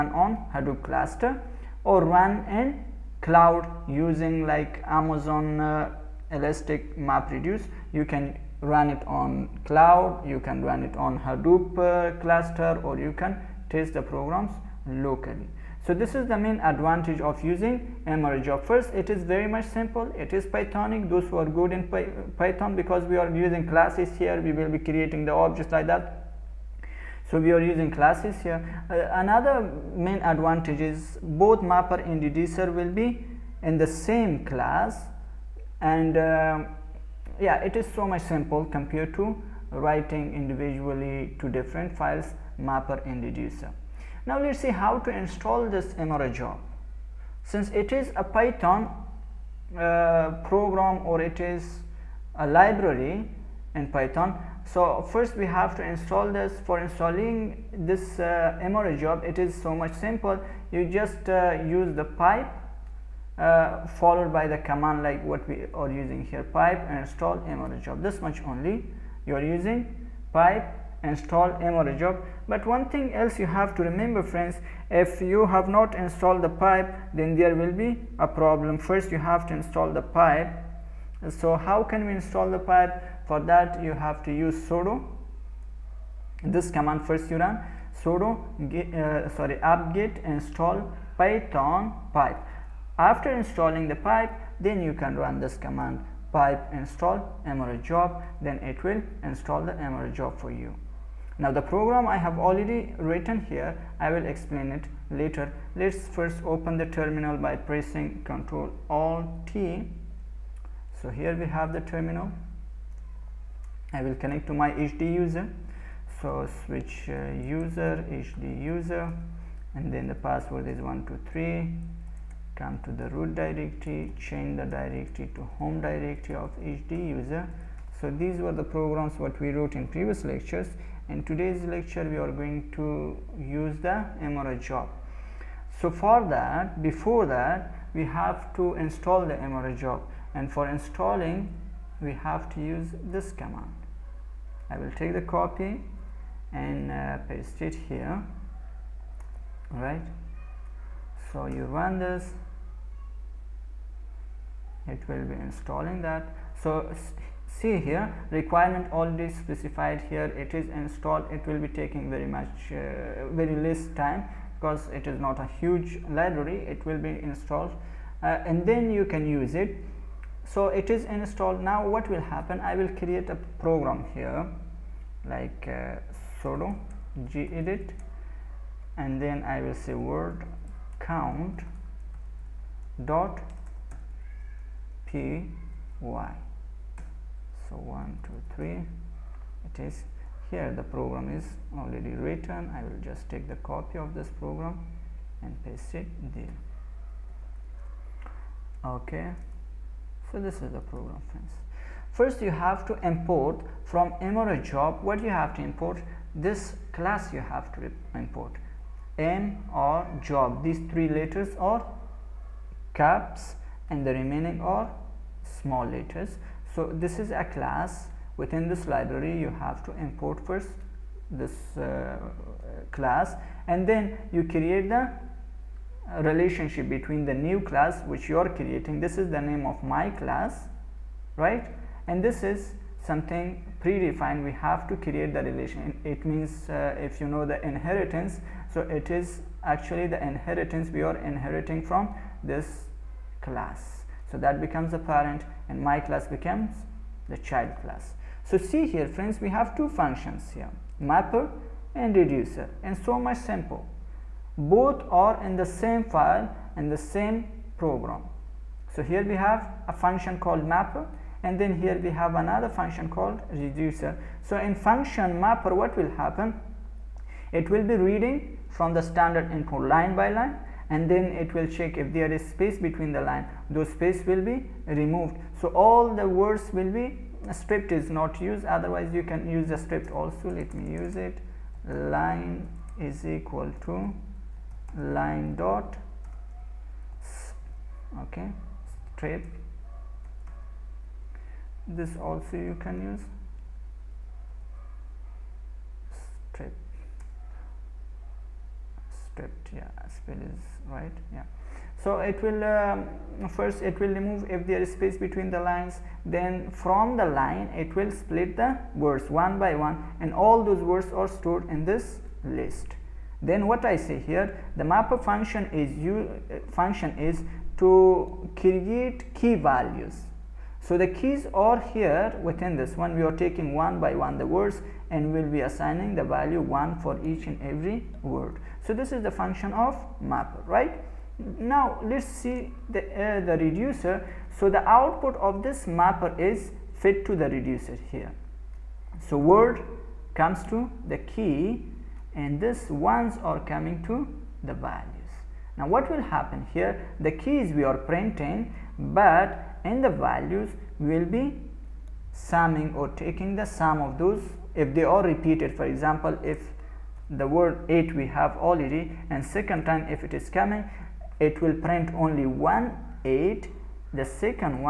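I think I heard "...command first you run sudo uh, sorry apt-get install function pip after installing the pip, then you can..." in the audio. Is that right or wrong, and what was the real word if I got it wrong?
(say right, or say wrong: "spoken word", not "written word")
wrong: "python", not "function".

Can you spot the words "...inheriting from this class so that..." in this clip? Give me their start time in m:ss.
4:01.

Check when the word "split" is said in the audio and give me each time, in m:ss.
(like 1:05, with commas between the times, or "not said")
5:08.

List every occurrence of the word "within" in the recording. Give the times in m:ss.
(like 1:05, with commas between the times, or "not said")
3:38, 5:22.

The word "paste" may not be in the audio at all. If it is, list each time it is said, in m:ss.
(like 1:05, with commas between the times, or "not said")
2:27, 3:15.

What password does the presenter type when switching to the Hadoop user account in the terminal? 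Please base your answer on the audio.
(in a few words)
123.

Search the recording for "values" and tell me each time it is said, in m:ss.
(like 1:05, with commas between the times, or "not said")
5:19, 5:26, 5:44, 5:50.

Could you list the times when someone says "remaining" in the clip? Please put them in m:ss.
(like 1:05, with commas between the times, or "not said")
3:34.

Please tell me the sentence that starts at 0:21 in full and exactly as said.
Those who are good in Py Python, because we are using classes here, we will be creating the objects like that.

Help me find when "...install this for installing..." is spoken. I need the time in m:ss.
0:55.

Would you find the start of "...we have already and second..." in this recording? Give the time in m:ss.
5:58.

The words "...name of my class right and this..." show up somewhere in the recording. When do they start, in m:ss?
3:49.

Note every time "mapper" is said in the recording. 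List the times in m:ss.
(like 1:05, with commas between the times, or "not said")
0:31, 0:42, 4:10, 4:20, 4:25, 5:14, 5:30, 5:35.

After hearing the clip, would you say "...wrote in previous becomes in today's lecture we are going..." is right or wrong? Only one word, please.
wrong.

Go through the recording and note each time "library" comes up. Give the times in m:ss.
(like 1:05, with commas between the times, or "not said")
0:52, 2:46, 3:38.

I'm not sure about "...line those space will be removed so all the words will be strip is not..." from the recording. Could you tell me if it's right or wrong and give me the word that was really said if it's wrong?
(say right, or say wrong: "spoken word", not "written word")
right.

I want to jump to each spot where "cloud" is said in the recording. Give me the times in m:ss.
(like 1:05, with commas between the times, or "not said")
0:03, 0:09.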